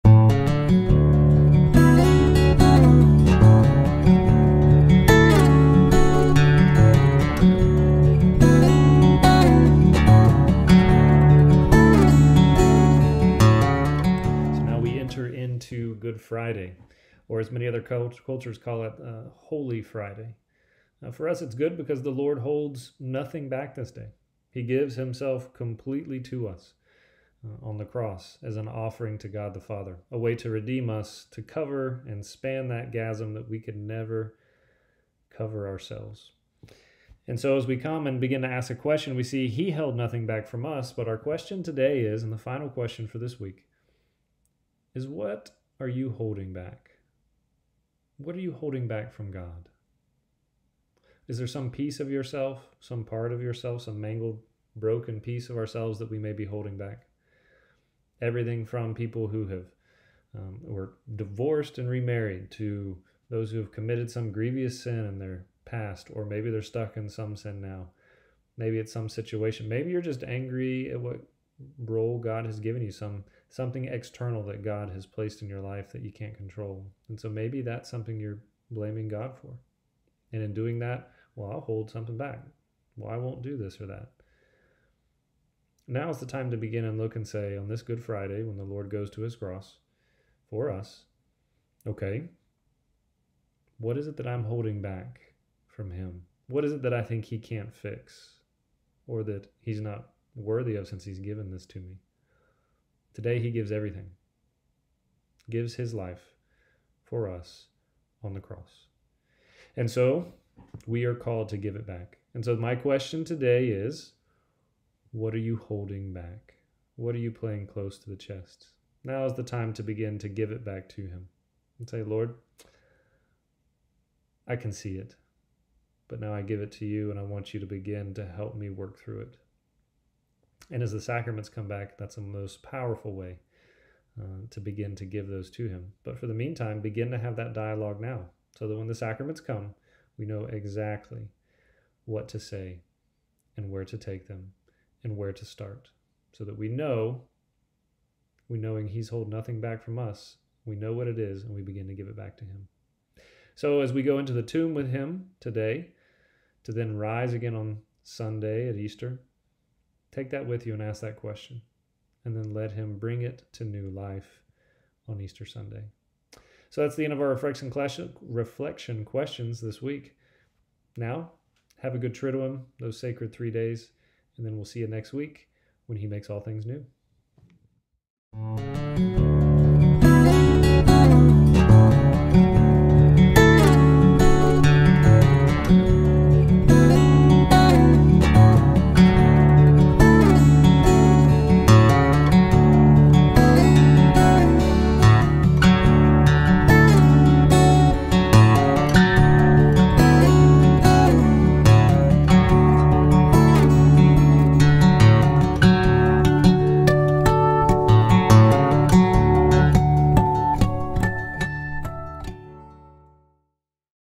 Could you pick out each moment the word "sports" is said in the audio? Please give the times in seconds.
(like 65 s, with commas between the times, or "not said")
not said.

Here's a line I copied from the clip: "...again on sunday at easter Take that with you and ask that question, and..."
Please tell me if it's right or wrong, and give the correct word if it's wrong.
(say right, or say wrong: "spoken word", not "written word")
right.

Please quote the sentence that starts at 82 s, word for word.
Well, I won't do this or that.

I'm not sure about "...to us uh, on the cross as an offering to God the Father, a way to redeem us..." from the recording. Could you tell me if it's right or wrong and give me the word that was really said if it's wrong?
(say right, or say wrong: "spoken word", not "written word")
right.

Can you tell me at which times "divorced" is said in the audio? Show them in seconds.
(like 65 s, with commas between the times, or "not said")
61 s.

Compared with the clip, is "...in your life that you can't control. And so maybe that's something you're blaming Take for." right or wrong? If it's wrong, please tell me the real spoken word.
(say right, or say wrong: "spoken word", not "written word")
wrong: "God", not "Take".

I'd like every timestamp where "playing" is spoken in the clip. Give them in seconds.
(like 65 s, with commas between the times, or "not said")
117 s.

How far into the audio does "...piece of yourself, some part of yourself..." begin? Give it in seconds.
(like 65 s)
51 s.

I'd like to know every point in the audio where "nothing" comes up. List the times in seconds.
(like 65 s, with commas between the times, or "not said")
22 s, 39 s, 149 s.